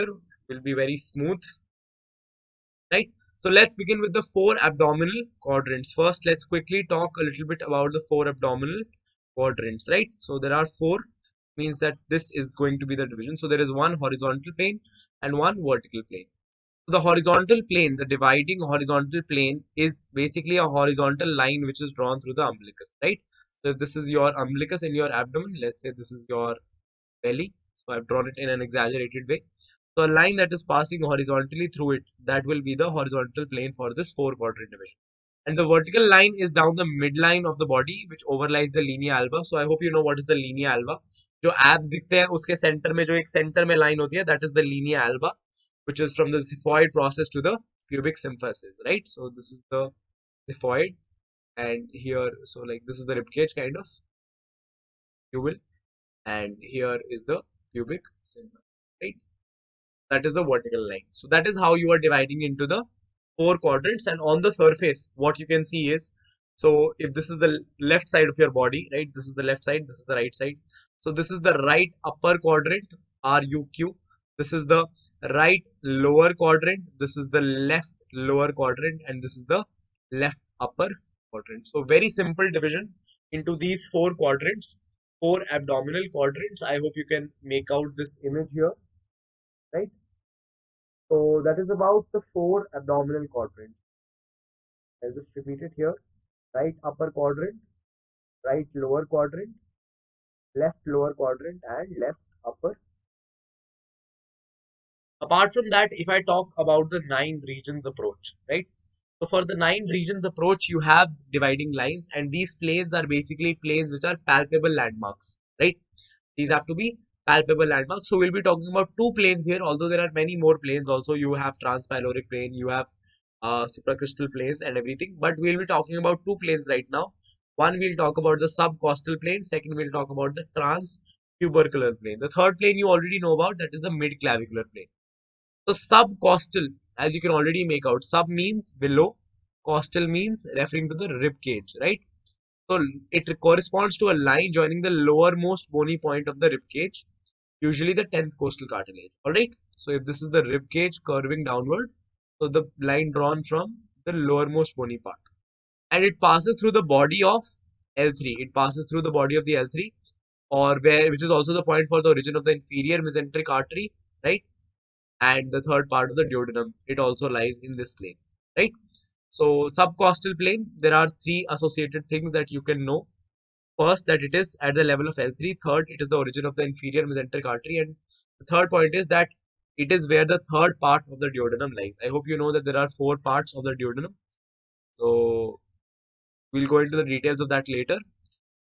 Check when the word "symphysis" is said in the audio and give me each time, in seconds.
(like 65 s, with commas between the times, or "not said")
48 s, 58 s.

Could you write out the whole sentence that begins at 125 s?
But we'll be talking about two planes right now.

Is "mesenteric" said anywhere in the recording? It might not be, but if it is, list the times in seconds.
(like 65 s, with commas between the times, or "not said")
163 s, 177 s.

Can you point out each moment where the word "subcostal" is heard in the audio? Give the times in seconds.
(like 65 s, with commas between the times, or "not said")
128 s, 135 s, 169 s.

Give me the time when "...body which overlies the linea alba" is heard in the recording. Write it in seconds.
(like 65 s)
37 s.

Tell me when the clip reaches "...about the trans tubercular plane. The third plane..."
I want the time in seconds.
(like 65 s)
130 s.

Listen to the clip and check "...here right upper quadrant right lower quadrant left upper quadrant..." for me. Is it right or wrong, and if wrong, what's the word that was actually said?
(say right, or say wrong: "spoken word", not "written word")
wrong: "lower", not "upper".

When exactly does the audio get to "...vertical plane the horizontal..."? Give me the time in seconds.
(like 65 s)
15 s.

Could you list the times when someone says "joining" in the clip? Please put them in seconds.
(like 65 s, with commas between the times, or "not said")
144 s.